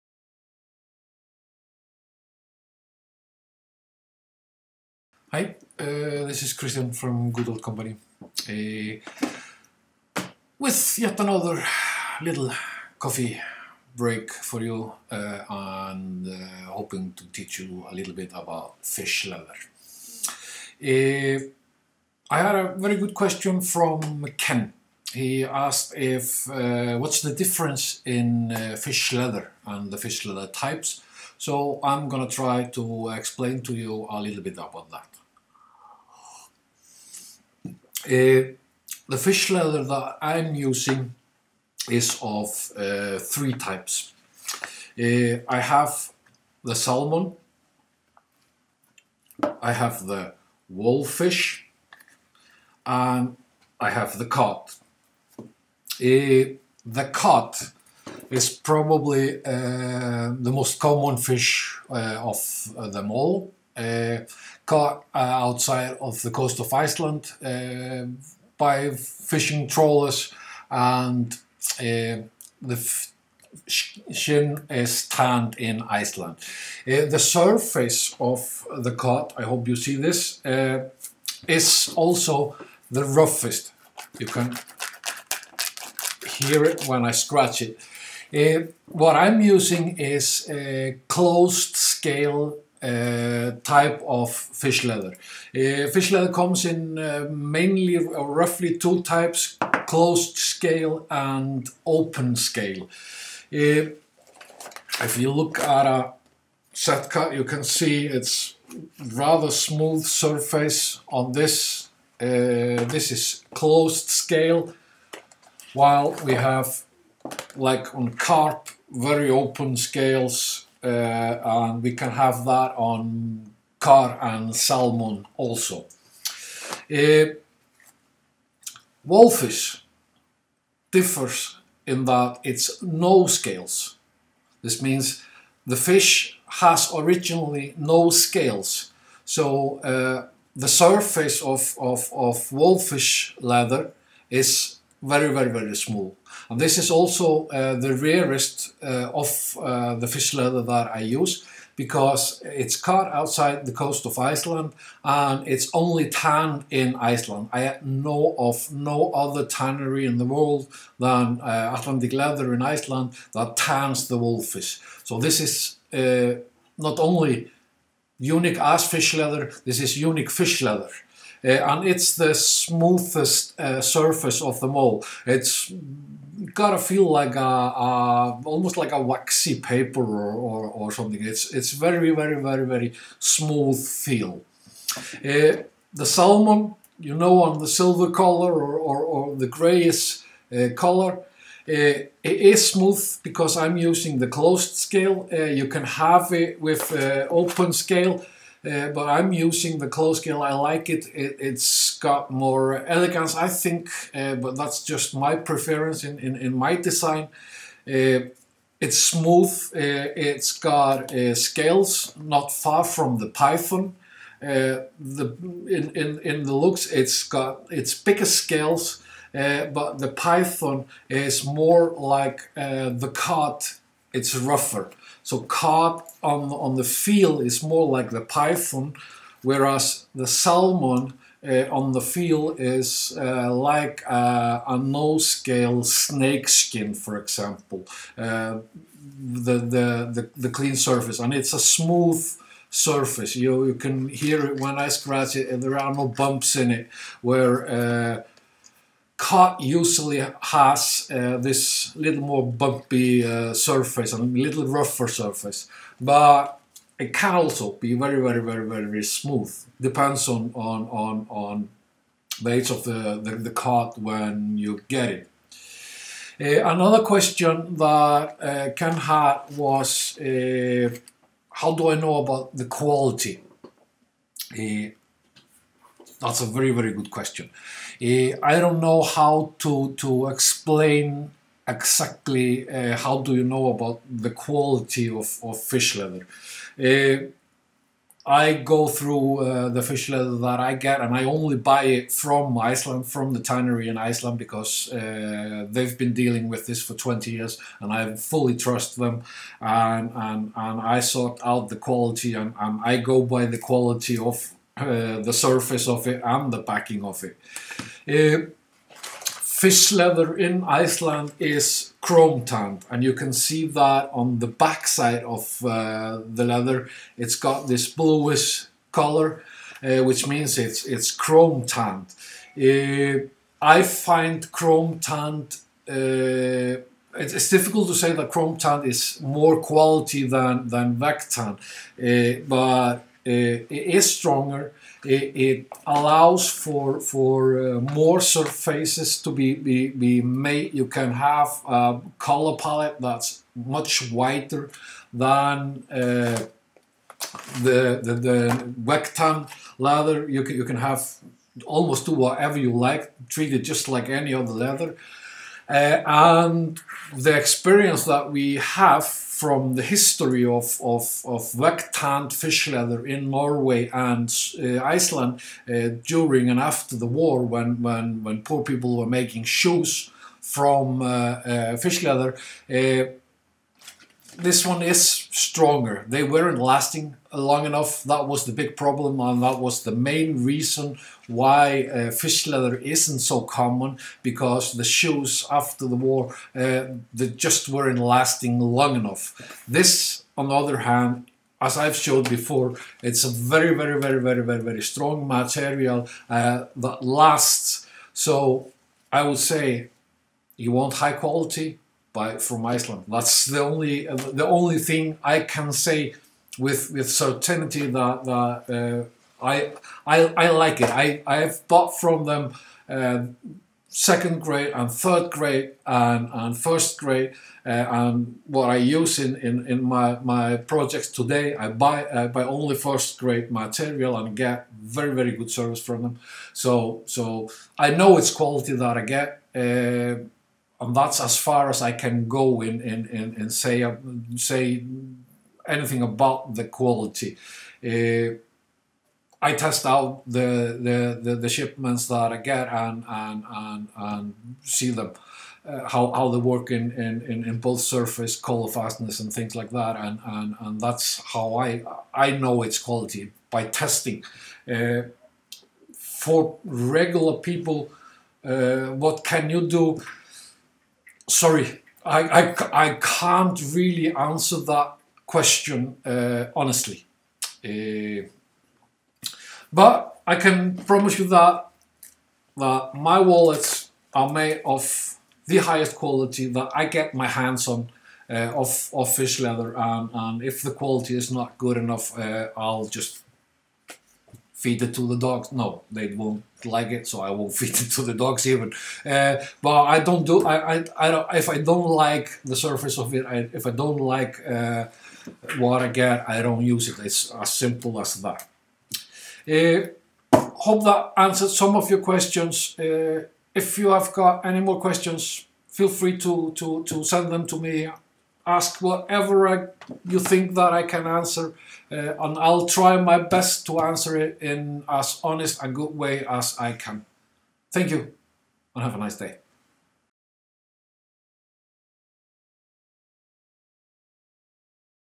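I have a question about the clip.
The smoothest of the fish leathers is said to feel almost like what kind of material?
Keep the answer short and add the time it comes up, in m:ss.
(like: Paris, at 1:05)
Waxy paper, at 2:59.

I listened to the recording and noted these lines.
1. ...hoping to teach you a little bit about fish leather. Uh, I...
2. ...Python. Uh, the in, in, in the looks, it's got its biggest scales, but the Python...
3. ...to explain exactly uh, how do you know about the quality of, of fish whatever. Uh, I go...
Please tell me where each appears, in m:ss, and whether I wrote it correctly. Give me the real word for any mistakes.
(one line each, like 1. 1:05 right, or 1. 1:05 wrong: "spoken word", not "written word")
1. 0:16 right
2. 3:33 right
3. 4:39 wrong: "leather", not "whatever".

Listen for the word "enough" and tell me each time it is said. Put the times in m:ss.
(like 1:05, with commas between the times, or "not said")
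6:17, 6:28, 8:01.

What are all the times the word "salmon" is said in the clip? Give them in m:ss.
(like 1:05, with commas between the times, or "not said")
0:46, 2:04, 3:06, 3:50.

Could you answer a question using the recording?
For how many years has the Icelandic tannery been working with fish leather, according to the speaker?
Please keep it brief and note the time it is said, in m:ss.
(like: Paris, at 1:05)
20 years, at 4:56.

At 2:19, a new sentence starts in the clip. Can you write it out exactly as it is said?
So uh, the surface of, of, of wolffish leather is very, very, very small.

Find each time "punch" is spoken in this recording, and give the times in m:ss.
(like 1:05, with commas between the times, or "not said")
not said.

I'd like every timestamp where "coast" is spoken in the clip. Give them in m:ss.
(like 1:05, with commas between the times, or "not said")
1:06, 2:33.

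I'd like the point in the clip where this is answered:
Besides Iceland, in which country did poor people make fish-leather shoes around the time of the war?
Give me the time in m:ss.
6:03.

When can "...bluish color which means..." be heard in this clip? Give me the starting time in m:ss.
5:17.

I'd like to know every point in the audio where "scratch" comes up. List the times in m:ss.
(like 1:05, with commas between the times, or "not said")
1:27, 4:04.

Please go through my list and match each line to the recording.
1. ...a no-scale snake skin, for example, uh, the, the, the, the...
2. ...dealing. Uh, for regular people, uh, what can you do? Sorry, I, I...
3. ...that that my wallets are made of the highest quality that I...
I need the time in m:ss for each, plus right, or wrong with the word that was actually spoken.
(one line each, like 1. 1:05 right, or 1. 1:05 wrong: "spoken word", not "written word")
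1. 3:54 right
2. 7:33 wrong: "testing", not "dealing"
3. 7:51 right.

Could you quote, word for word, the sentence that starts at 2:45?
So this is uh, not only unique as fish leather, this is unique fish leather.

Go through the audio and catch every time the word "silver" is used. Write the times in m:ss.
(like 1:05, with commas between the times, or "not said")
3:07.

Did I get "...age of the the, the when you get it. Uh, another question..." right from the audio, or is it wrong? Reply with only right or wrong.
right.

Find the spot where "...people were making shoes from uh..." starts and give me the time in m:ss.
6:08.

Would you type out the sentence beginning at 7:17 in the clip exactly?
Uh, I test out the, the, the, the, shipments that I get and, and, and, and see them.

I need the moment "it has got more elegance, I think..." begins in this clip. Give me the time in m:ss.
3:21.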